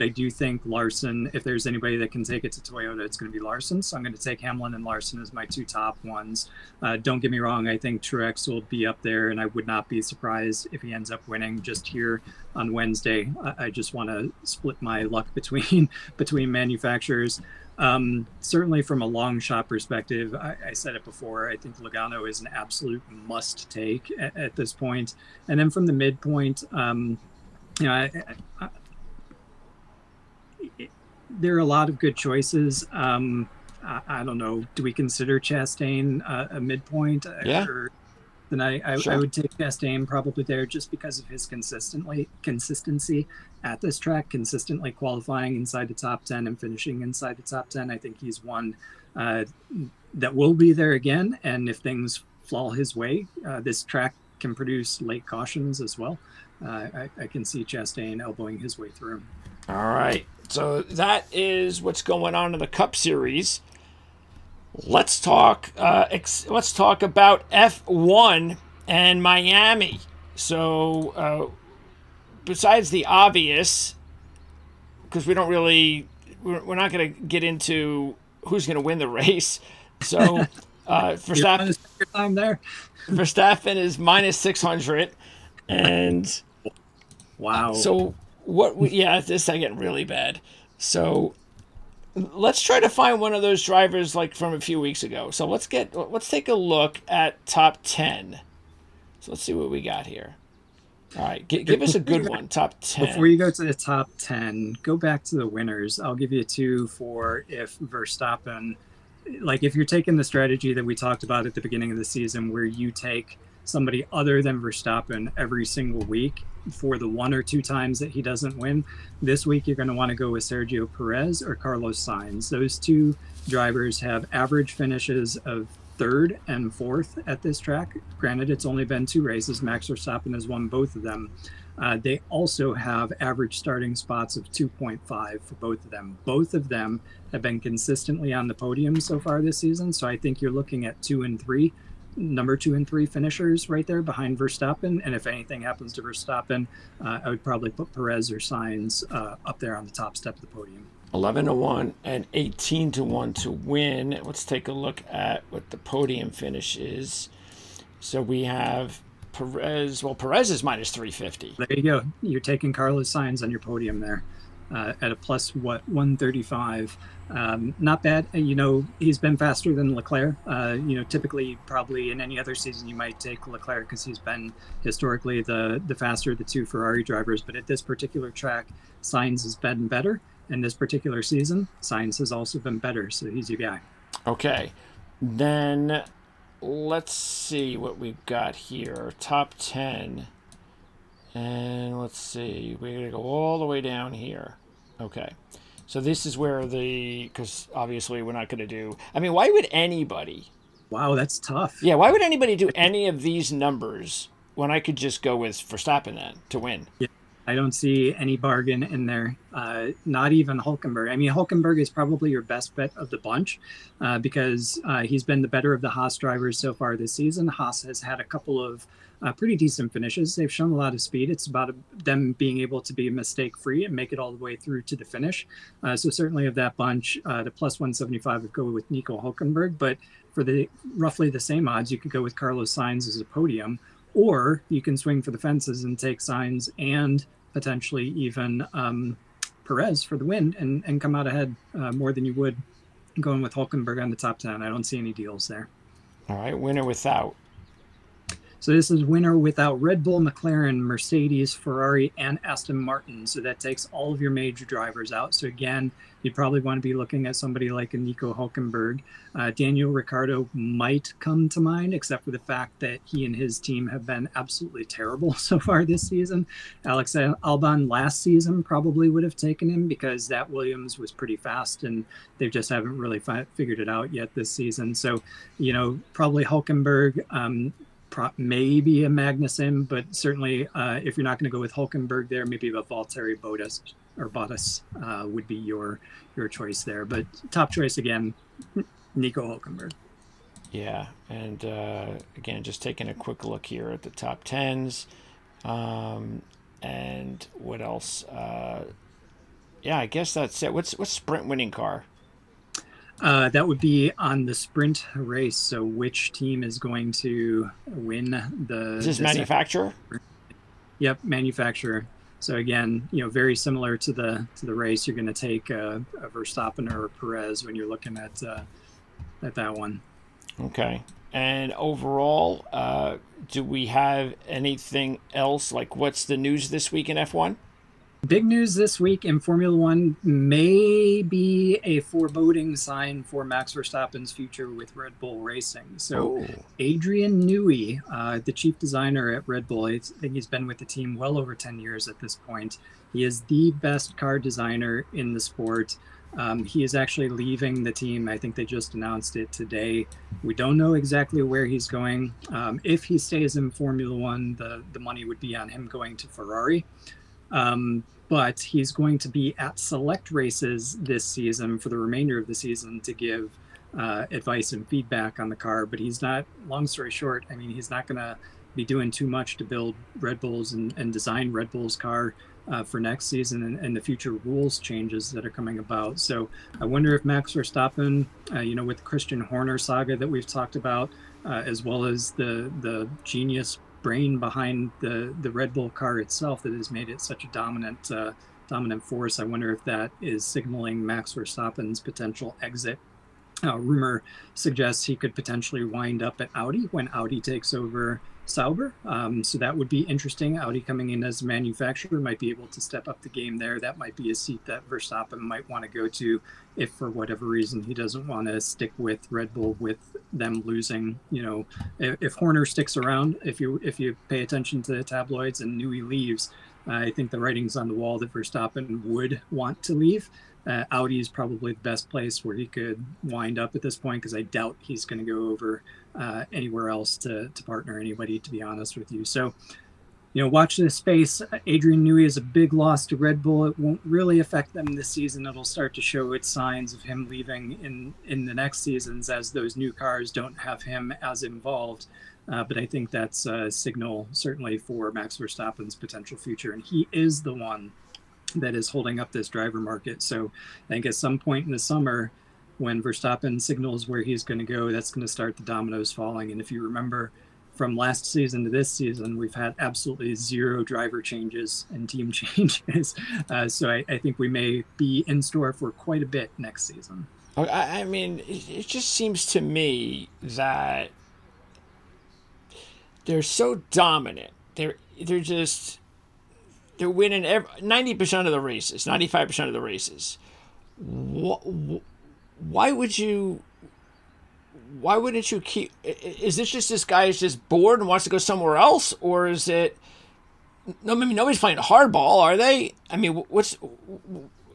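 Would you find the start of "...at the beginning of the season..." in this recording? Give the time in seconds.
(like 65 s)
111 s.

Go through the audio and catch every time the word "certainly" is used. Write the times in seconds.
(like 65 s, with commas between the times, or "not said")
18 s, 226 s, 280 s, 444 s.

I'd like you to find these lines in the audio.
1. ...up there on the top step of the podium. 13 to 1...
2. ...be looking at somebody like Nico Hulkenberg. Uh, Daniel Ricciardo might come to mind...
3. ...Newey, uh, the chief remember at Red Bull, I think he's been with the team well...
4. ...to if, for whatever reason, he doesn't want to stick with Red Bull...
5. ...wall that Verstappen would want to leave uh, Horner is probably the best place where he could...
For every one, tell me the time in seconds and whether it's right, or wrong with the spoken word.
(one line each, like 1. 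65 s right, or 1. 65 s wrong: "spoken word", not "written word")
1. 149 s wrong: "11", not "13"
2. 256 s right
3. 337 s wrong: "designer", not "remember"
4. 406 s right
5. 417 s wrong: "Audi", not "Horner".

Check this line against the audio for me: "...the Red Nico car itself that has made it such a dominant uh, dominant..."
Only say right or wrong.
wrong.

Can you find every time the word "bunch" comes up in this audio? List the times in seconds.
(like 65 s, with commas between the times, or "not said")
213 s, 226 s.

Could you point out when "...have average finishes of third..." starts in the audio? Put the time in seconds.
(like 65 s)
124 s.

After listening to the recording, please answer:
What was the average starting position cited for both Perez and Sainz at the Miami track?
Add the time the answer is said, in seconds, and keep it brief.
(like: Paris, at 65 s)
2.5, at 134 s.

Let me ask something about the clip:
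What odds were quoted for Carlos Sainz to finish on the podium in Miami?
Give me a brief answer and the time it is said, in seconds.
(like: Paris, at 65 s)
+135, at 165 s.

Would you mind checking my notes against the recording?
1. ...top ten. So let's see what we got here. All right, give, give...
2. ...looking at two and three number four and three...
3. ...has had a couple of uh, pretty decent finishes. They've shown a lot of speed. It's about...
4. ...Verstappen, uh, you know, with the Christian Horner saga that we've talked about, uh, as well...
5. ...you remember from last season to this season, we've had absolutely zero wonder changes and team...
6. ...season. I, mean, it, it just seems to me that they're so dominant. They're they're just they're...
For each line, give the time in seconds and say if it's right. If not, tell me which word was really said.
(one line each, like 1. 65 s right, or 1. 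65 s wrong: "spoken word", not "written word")
1. 97 s right
2. 140 s wrong: "two", not "four"
3. 217 s right
4. 377 s right
5. 456 s wrong: "driver", not "wonder"
6. 466 s right.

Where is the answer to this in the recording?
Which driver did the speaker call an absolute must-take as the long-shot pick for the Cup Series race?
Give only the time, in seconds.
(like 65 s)
21 s.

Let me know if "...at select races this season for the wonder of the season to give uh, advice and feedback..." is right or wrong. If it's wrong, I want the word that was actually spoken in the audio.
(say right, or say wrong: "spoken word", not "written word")
wrong: "remainder", not "wonder".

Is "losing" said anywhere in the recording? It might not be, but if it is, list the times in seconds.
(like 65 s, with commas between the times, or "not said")
410 s.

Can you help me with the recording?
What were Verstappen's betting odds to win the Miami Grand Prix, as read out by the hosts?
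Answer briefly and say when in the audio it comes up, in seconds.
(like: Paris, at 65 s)
-600, at 83 s.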